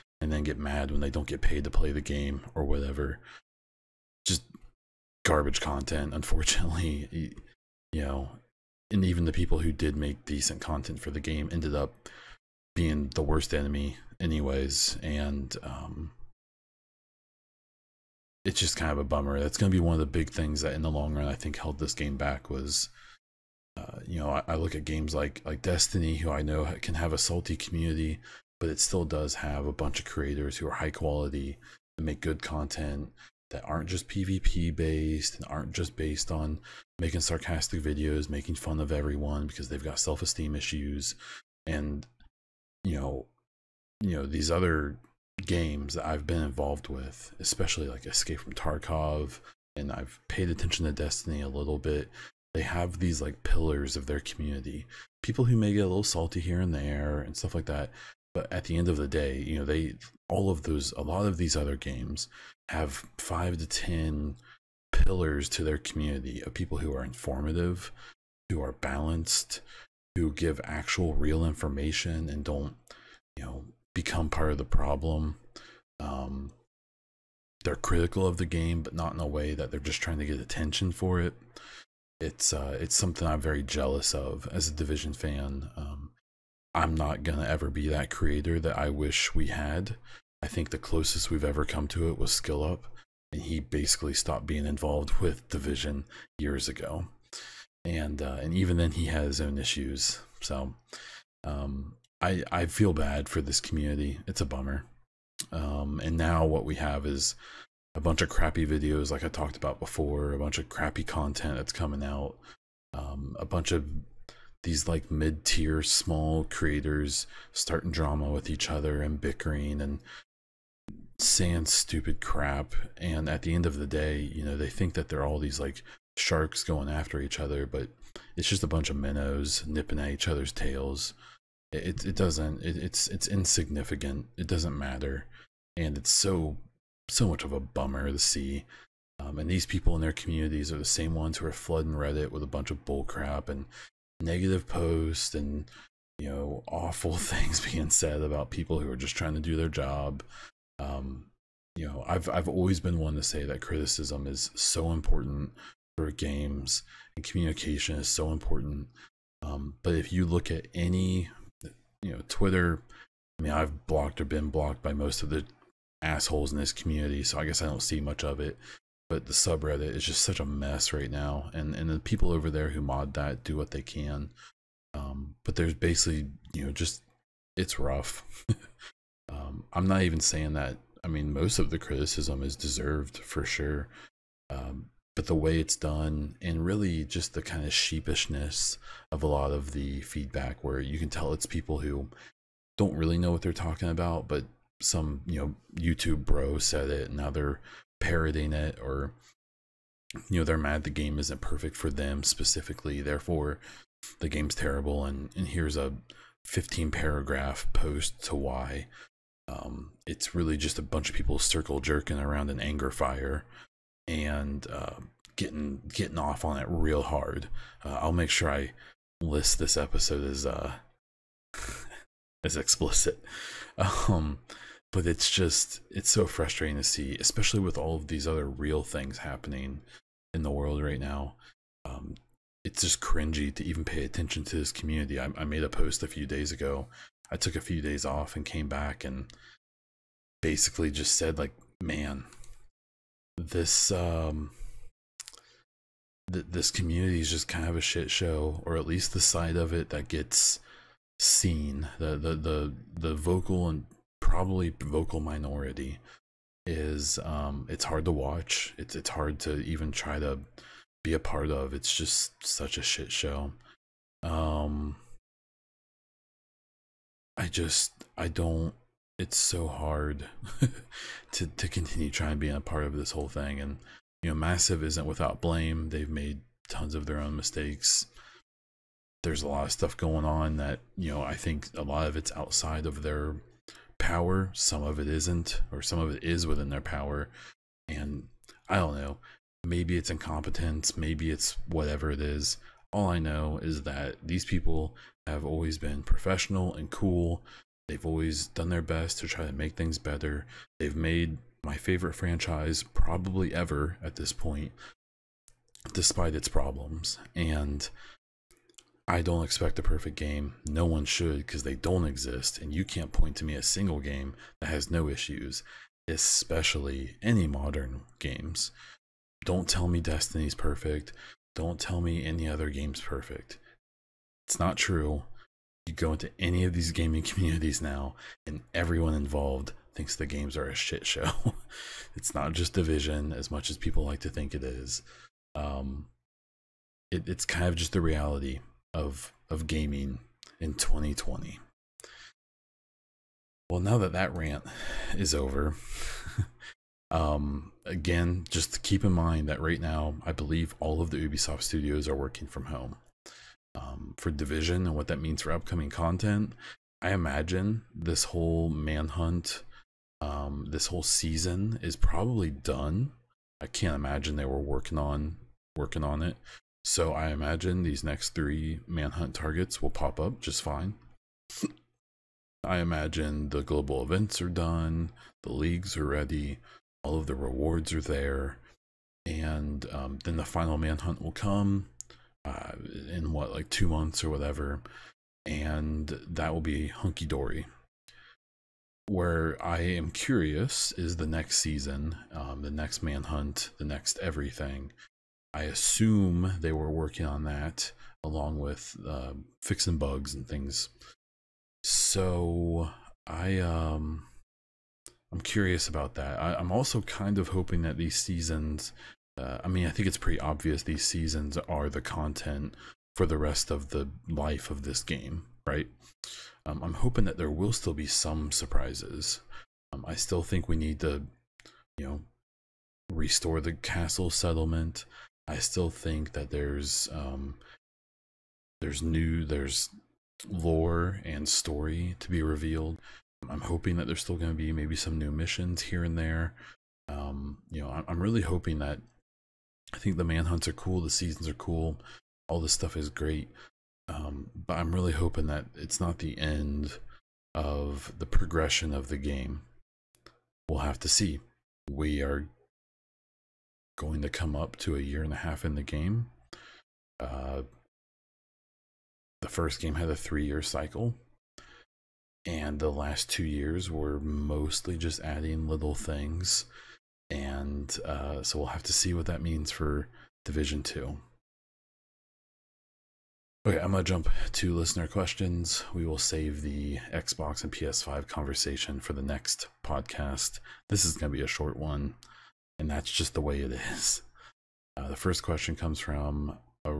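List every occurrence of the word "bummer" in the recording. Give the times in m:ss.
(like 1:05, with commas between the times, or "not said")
0:19, 1:44, 2:17.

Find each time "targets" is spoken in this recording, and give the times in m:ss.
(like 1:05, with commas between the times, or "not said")
6:09.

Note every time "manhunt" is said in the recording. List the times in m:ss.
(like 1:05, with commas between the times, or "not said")
5:58, 6:08, 6:20, 6:33, 7:20.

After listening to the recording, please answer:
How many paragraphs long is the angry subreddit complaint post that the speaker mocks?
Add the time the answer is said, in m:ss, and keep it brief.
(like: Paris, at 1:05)
15, at 3:26.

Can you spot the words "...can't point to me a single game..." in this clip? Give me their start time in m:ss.
5:12.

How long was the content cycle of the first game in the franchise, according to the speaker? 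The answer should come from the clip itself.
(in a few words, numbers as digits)
3 years.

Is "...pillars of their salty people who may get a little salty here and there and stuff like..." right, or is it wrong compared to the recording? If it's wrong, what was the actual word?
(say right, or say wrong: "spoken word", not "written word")
wrong: "community", not "salty".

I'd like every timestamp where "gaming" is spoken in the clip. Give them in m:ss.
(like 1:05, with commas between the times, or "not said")
5:26, 5:39.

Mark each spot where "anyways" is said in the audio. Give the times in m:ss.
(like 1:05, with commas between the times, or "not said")
0:14.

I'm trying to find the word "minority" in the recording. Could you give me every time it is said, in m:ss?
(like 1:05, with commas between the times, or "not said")
4:15.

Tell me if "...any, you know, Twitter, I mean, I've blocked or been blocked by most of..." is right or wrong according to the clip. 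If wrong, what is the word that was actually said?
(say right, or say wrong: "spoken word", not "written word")
right.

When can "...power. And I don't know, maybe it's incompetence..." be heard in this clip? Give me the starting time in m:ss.
4:46.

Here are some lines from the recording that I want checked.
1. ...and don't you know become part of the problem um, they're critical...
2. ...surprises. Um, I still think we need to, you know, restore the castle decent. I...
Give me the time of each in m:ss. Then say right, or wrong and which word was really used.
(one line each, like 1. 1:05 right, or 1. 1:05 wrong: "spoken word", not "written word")
1. 1:12 right
2. 6:58 wrong: "settlement", not "decent".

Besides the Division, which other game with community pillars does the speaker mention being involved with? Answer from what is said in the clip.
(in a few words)
Escape from Tarkov.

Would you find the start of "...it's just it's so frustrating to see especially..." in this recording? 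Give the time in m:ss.
3:45.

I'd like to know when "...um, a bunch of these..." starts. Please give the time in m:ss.
1:52.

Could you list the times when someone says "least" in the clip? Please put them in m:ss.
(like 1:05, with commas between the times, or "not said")
4:08.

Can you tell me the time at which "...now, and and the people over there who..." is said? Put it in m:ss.
2:51.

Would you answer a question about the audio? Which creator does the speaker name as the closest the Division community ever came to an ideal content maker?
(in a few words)
Skill Up.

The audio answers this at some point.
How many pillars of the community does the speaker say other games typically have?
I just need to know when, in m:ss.
1:03.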